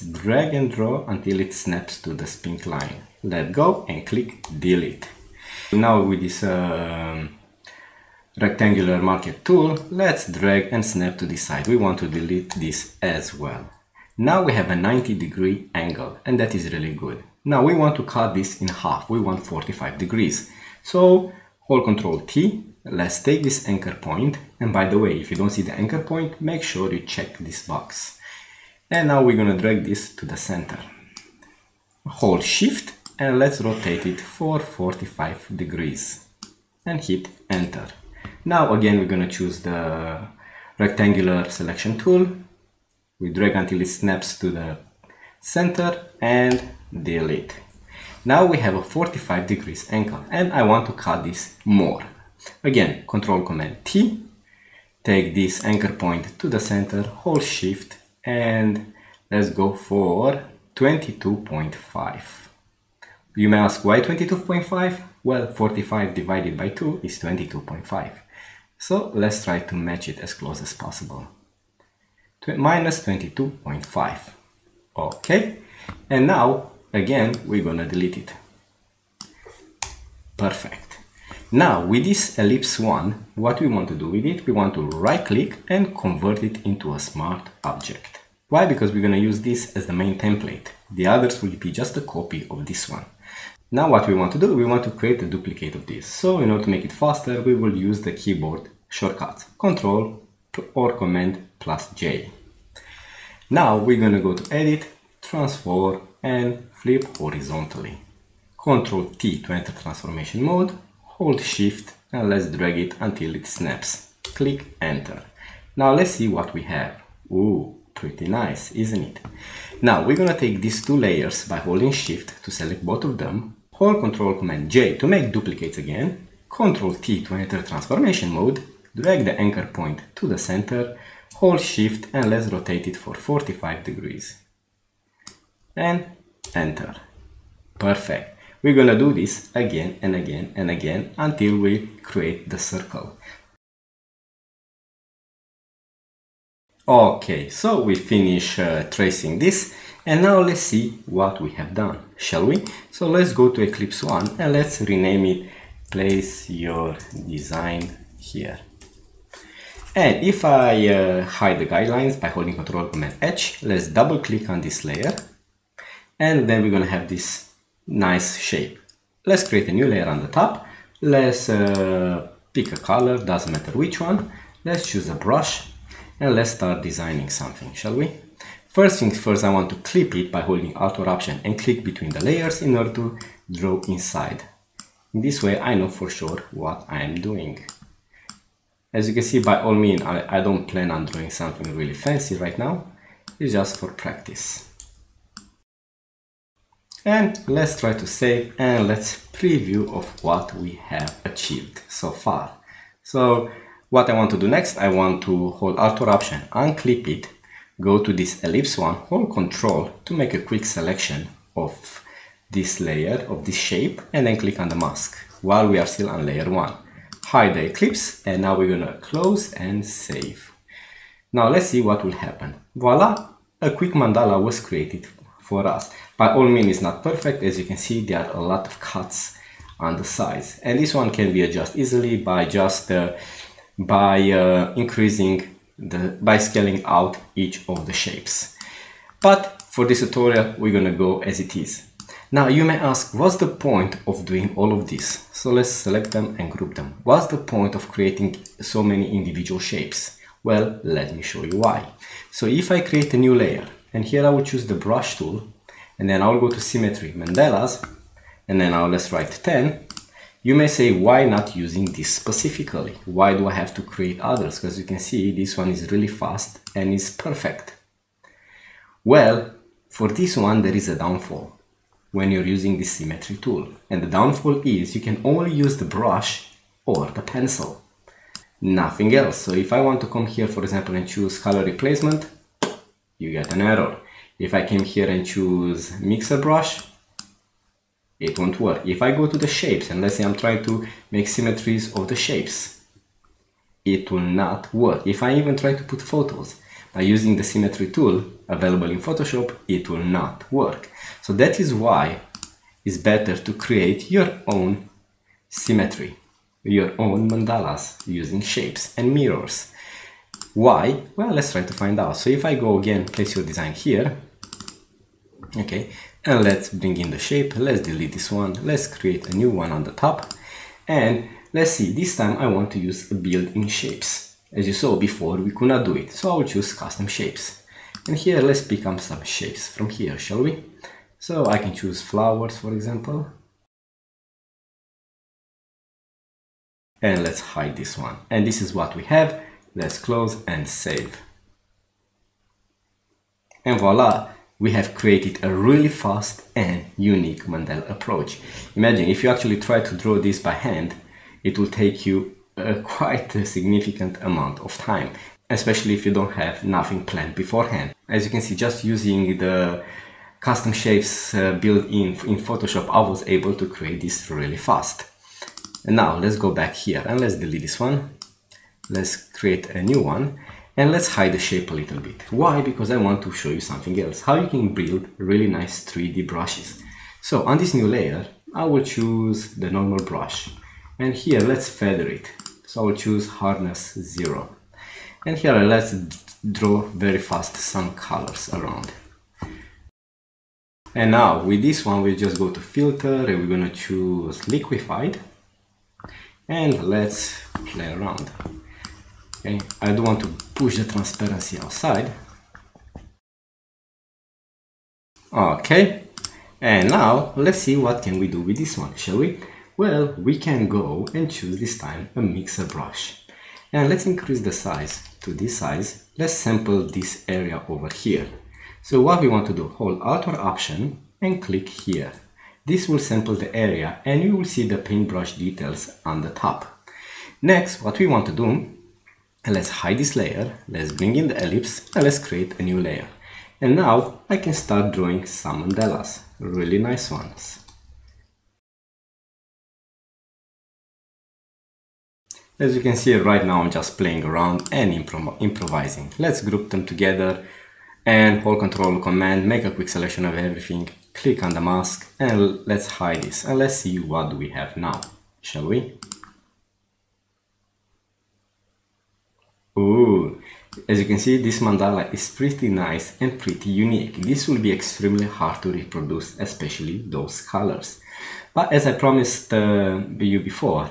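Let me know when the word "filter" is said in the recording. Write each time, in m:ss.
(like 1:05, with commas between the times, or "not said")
6:32.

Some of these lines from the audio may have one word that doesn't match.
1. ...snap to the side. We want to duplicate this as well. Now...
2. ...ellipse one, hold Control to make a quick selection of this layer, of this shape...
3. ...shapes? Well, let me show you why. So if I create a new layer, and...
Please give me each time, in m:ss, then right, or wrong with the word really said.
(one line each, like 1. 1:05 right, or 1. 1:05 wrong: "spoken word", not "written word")
1. 0:10 wrong: "delete", not "duplicate"
2. 3:28 right
3. 4:09 right.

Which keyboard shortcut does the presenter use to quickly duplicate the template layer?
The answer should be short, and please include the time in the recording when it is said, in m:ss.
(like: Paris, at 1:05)
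Control or Command plus J, at 1:39.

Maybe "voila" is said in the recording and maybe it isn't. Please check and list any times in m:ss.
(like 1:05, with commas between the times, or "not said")
3:42, 5:43.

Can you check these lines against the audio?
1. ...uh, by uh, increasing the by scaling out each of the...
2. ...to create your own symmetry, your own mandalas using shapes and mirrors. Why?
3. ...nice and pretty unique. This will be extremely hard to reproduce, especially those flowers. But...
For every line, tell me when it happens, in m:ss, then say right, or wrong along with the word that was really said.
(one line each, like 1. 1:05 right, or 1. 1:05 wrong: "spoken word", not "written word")
1. 3:52 right
2. 5:03 right
3. 7:42 wrong: "colors", not "flowers".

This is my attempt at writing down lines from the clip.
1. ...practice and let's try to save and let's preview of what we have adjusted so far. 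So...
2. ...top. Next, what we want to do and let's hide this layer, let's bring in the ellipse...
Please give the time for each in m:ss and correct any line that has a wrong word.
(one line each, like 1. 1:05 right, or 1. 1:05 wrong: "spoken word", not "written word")
1. 3:13 wrong: "achieved", not "adjusted"
2. 7:06 right.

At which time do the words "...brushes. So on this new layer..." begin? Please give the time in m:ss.
6:16.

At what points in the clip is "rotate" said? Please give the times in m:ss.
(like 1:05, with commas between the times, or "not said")
0:33, 2:12.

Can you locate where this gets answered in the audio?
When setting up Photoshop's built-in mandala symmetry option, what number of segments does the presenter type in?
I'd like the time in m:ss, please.
4:18.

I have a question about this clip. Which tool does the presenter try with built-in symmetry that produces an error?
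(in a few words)
color replacement.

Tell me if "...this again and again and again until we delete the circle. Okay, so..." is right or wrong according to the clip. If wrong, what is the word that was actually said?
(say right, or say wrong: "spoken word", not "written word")
wrong: "create", not "delete".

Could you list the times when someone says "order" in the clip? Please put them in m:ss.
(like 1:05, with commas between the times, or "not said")
1:36, 3:02.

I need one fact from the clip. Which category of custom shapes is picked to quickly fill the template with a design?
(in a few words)
flowers.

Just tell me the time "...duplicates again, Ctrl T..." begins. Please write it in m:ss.
2:05.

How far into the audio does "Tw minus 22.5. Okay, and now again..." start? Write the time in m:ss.
1:12.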